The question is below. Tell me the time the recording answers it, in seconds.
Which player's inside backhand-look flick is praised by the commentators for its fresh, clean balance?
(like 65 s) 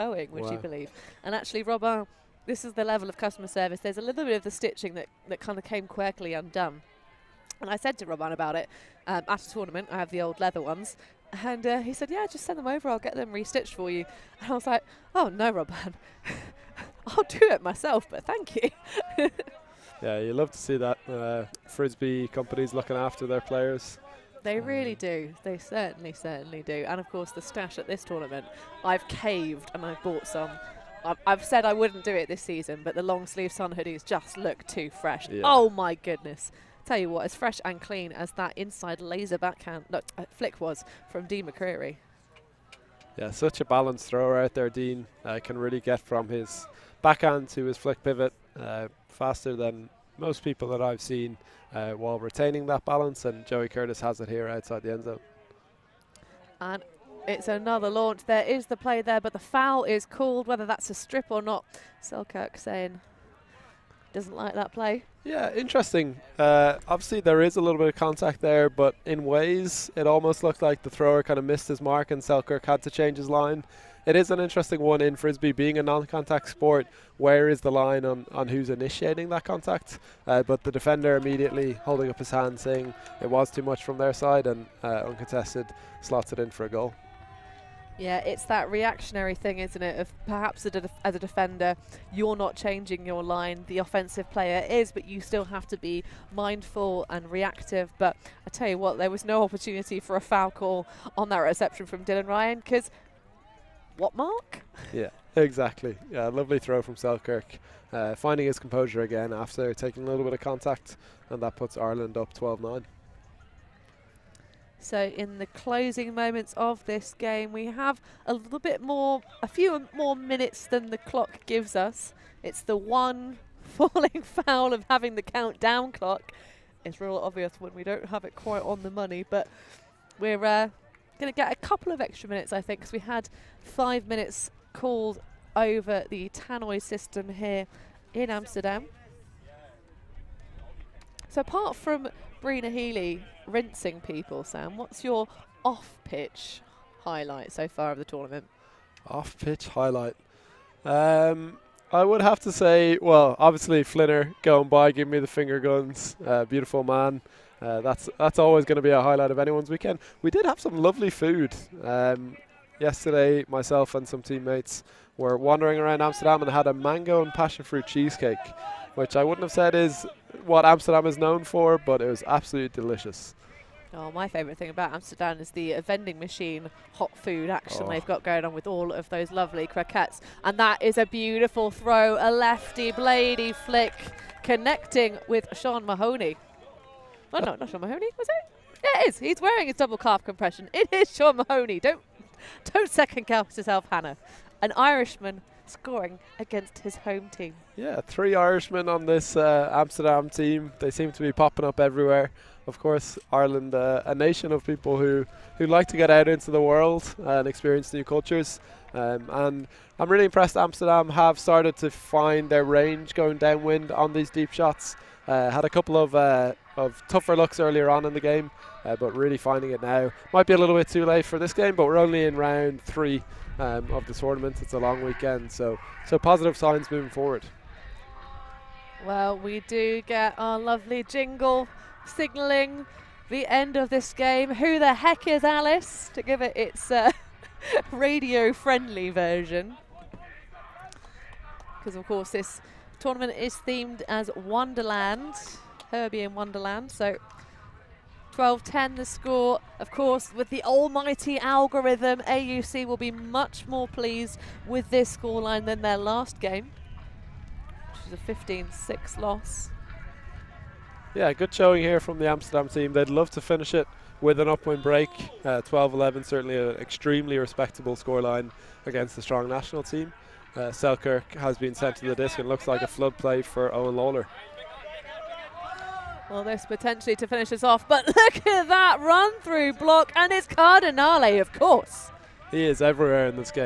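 41 s.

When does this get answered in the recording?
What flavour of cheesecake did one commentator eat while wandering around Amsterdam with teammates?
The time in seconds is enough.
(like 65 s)
166 s.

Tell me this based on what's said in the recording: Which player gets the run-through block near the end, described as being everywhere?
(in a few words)
Cardinale.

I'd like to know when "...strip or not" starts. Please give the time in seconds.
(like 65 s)
60 s.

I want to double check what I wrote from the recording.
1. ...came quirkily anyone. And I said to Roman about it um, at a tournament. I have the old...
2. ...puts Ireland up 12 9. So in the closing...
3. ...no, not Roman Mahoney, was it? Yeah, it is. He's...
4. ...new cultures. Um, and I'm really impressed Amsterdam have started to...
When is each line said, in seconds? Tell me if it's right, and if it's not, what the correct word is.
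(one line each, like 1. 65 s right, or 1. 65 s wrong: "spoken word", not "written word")
1. 5 s wrong: "undone", not "anyone"
2. 111 s right
3. 187 s wrong: "Sean", not "Roman"
4. 207 s right.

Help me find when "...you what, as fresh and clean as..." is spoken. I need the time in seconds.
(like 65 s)
36 s.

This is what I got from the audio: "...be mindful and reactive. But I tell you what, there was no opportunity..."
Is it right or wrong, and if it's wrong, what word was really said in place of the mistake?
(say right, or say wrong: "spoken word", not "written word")
right.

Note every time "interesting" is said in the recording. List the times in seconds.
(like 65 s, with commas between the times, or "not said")
65 s, 74 s.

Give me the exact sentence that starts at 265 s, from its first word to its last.
12-11, uh, certainly an extremely respectable scoreline against the strong national team.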